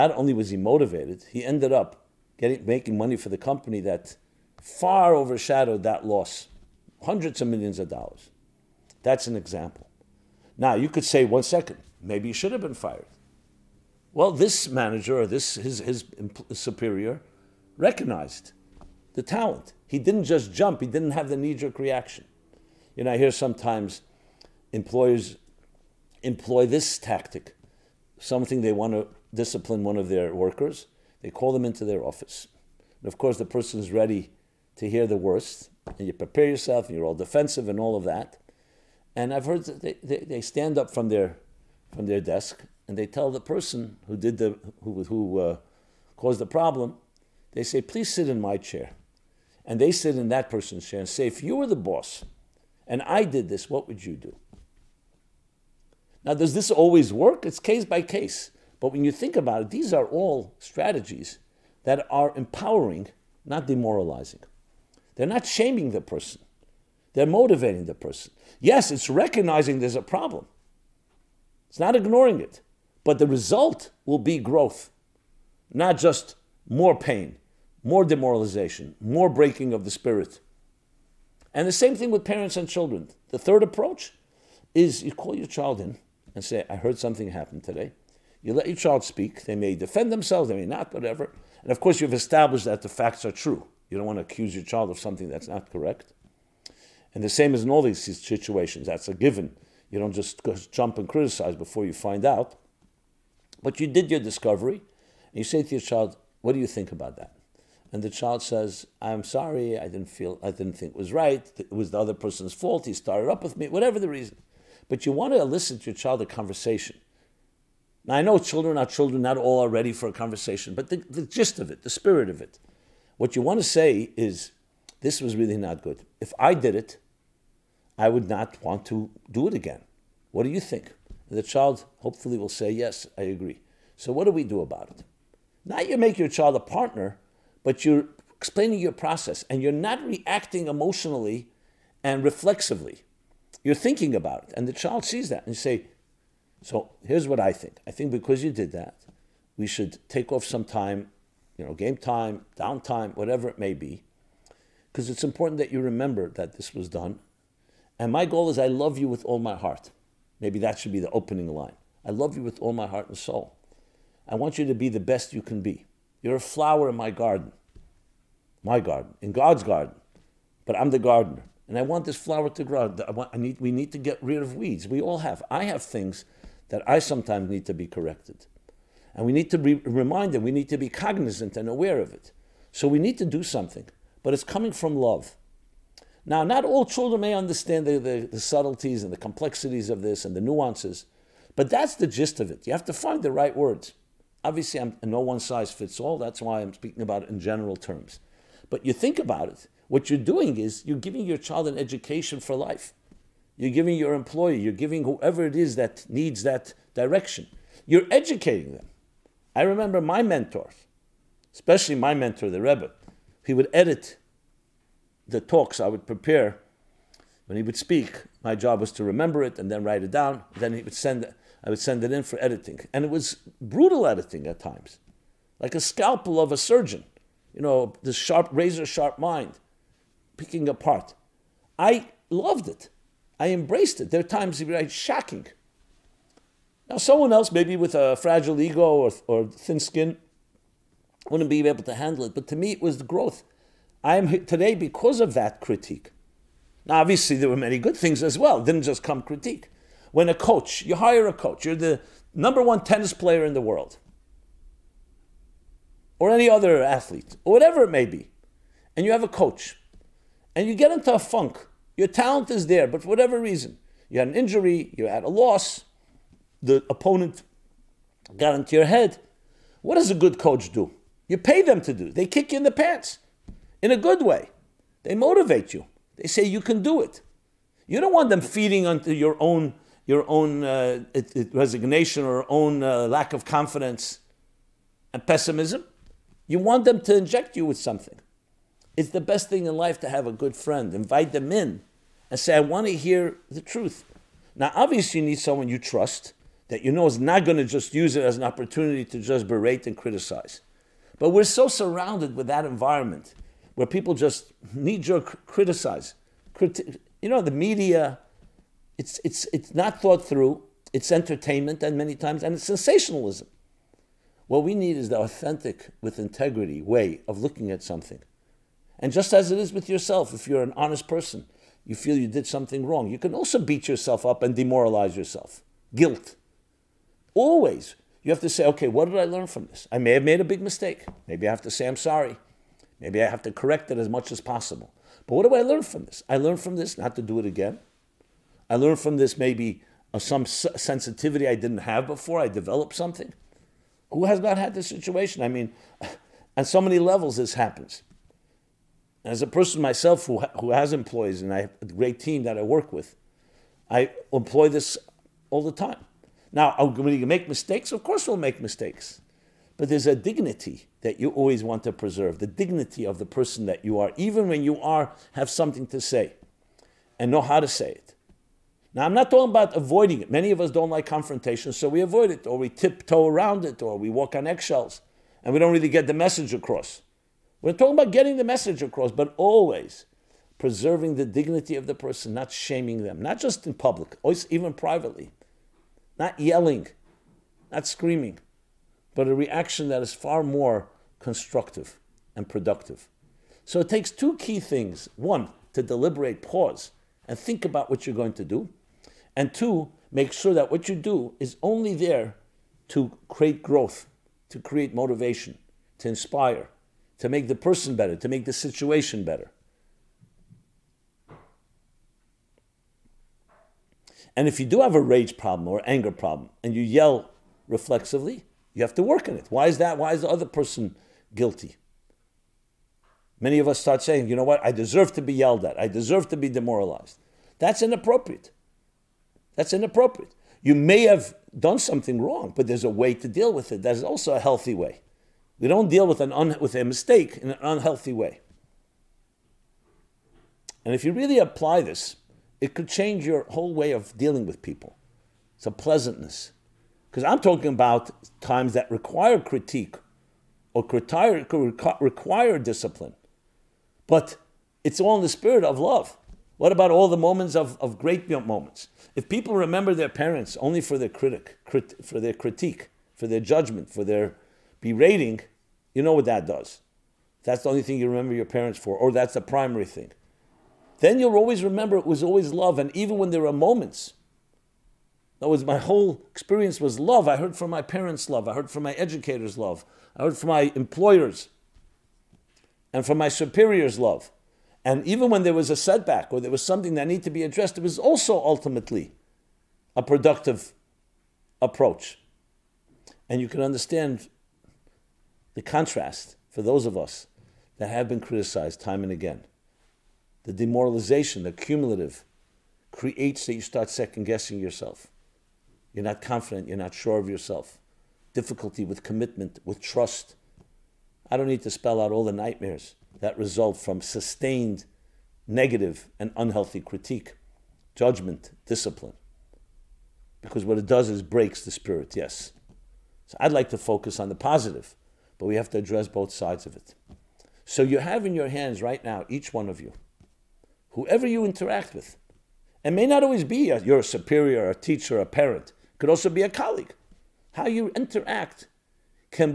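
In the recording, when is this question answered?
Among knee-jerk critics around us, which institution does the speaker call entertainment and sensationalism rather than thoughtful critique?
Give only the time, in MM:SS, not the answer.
05:07.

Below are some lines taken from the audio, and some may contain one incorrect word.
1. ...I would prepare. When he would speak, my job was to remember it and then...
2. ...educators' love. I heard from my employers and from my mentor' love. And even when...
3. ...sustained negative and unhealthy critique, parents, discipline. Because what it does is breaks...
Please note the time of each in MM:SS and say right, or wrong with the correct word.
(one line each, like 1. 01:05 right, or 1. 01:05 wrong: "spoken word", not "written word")
1. 03:35 right
2. 07:58 wrong: "superiors", not "mentor"
3. 08:34 wrong: "judgment", not "parents".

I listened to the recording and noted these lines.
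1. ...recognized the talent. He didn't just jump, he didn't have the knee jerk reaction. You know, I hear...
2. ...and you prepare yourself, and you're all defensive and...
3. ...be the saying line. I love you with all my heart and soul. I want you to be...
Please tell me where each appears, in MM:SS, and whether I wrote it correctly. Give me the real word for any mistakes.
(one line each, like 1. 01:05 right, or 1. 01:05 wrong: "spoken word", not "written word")
1. 00:17 right
2. 00:35 right
3. 02:40 wrong: "opening", not "saying".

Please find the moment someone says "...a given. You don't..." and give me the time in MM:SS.
01:39.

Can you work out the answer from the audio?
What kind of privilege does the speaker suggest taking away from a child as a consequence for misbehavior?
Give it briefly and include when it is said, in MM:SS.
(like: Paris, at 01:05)
game time, at 02:31.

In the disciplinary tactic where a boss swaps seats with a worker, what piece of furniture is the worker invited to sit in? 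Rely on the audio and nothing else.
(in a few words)
my chair.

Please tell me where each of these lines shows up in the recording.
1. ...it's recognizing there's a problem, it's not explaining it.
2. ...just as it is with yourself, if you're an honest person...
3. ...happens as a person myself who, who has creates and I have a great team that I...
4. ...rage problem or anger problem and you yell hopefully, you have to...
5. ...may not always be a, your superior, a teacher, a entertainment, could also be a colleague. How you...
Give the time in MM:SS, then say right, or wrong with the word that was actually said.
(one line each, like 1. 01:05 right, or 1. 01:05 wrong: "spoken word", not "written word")
1. 01:08 wrong: "ignoring", not "explaining"
2. 05:19 right
3. 05:47 wrong: "employees", not "creates"
4. 06:55 wrong: "reflexively", not "hopefully"
5. 08:52 wrong: "parent", not "entertainment".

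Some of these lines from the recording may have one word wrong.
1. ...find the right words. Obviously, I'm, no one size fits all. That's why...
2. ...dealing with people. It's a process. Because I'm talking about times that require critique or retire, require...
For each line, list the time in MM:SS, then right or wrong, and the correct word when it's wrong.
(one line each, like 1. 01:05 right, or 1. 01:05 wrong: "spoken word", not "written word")
1. 03:12 right
2. 07:24 wrong: "pleasantness", not "process".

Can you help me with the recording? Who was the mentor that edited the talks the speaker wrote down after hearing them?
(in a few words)
the Rebbe.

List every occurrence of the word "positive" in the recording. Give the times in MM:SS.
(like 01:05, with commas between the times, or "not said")
08:44.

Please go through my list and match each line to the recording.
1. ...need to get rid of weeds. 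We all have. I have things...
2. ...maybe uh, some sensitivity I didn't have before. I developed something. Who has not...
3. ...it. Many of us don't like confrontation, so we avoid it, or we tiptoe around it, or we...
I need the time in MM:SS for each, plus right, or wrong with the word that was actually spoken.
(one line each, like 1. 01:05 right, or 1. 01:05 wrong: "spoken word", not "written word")
1. 02:53 right
2. 05:39 right
3. 06:10 right.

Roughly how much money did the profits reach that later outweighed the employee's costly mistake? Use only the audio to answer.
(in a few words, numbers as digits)
hundreds of millions of dollars.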